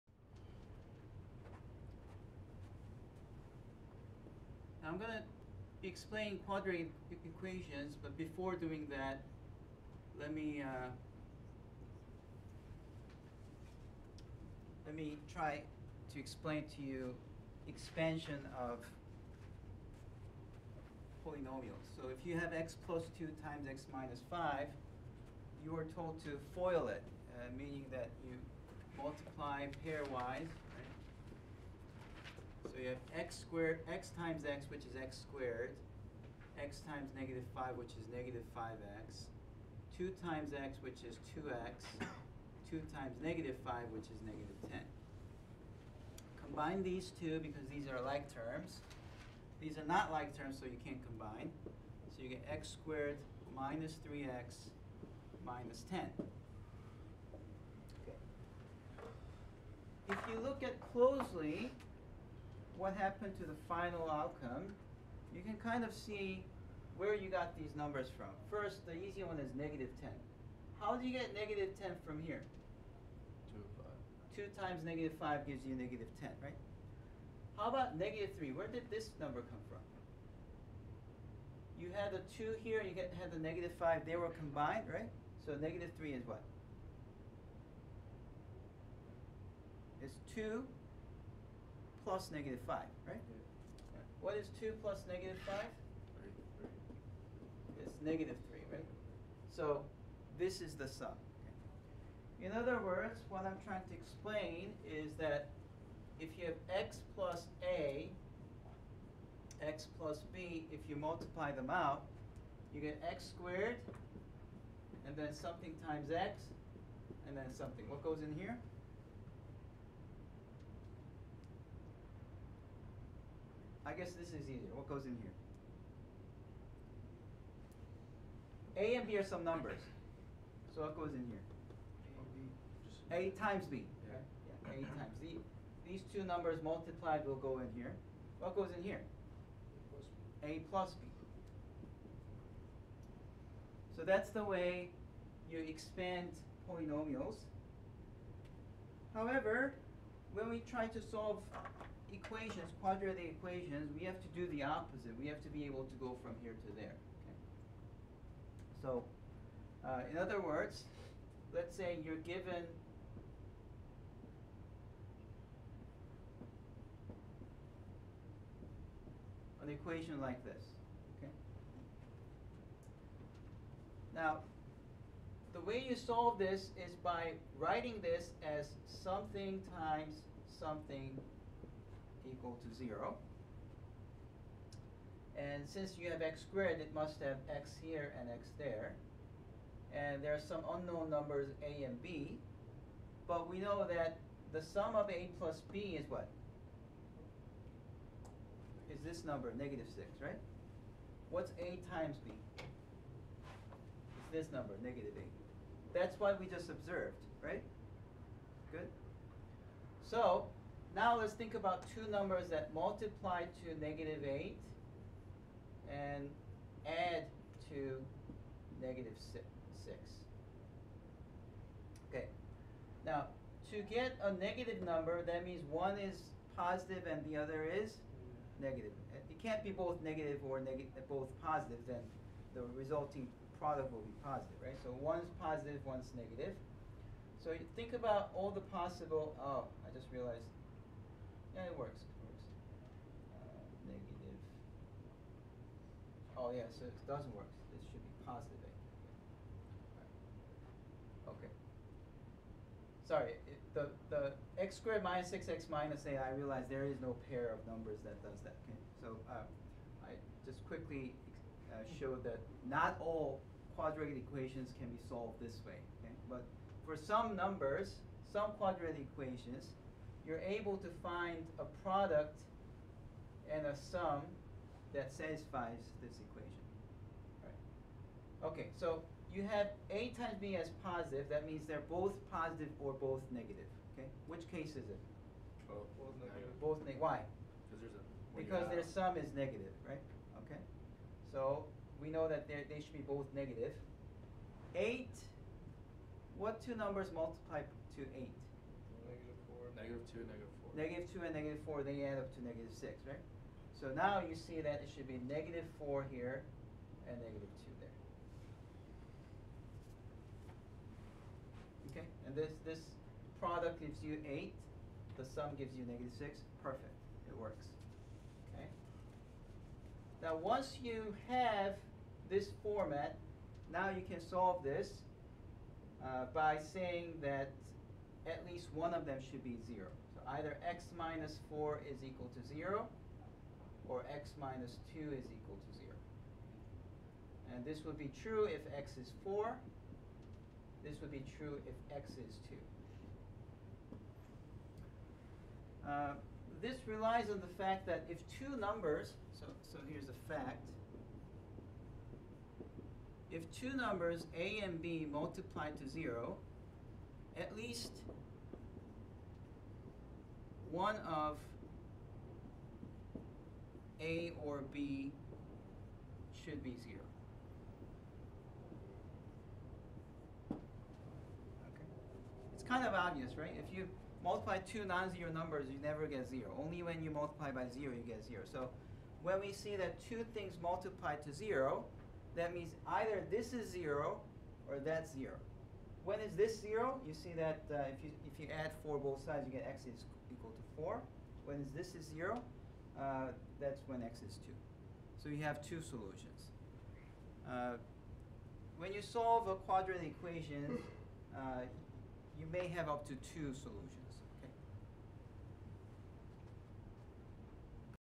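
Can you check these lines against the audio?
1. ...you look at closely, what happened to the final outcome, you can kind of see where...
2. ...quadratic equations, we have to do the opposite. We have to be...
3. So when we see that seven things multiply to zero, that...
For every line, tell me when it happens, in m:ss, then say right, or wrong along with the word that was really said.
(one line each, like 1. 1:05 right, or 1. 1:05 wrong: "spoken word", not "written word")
1. 1:00 right
2. 2:32 right
3. 6:18 wrong: "two", not "seven".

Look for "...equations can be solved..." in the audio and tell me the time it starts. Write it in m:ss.
4:24.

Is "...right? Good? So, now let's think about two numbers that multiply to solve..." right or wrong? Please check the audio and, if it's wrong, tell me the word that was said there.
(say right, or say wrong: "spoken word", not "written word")
wrong: "negative", not "solve".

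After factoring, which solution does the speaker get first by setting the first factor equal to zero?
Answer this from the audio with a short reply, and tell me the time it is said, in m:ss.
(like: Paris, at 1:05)
x = 4, at 5:38.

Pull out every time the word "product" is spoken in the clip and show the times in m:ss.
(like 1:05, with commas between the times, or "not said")
3:53, 4:31, 5:13.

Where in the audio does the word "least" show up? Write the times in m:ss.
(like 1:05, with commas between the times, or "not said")
5:28, 5:57.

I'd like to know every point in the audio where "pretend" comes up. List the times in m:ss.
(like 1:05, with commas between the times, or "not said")
not said.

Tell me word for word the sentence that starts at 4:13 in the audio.
Sorry, it, the, the x squared minus 6x minus minus a.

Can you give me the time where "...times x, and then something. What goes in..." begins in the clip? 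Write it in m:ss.
1:55.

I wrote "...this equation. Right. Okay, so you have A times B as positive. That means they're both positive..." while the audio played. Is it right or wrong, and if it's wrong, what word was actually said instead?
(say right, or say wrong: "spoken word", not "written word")
right.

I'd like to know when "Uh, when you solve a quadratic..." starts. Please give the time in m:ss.
6:37.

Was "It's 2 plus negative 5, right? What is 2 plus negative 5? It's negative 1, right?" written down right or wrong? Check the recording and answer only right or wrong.
wrong.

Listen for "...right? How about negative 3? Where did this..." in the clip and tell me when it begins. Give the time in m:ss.
1:16.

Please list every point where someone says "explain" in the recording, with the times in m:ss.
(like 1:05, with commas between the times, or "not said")
0:05, 0:16, 1:43.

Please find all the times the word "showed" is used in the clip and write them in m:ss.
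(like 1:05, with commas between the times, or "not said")
4:21.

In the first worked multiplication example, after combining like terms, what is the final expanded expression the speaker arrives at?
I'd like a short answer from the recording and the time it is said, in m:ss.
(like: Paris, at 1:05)
x² - 3x - 10, at 0:52.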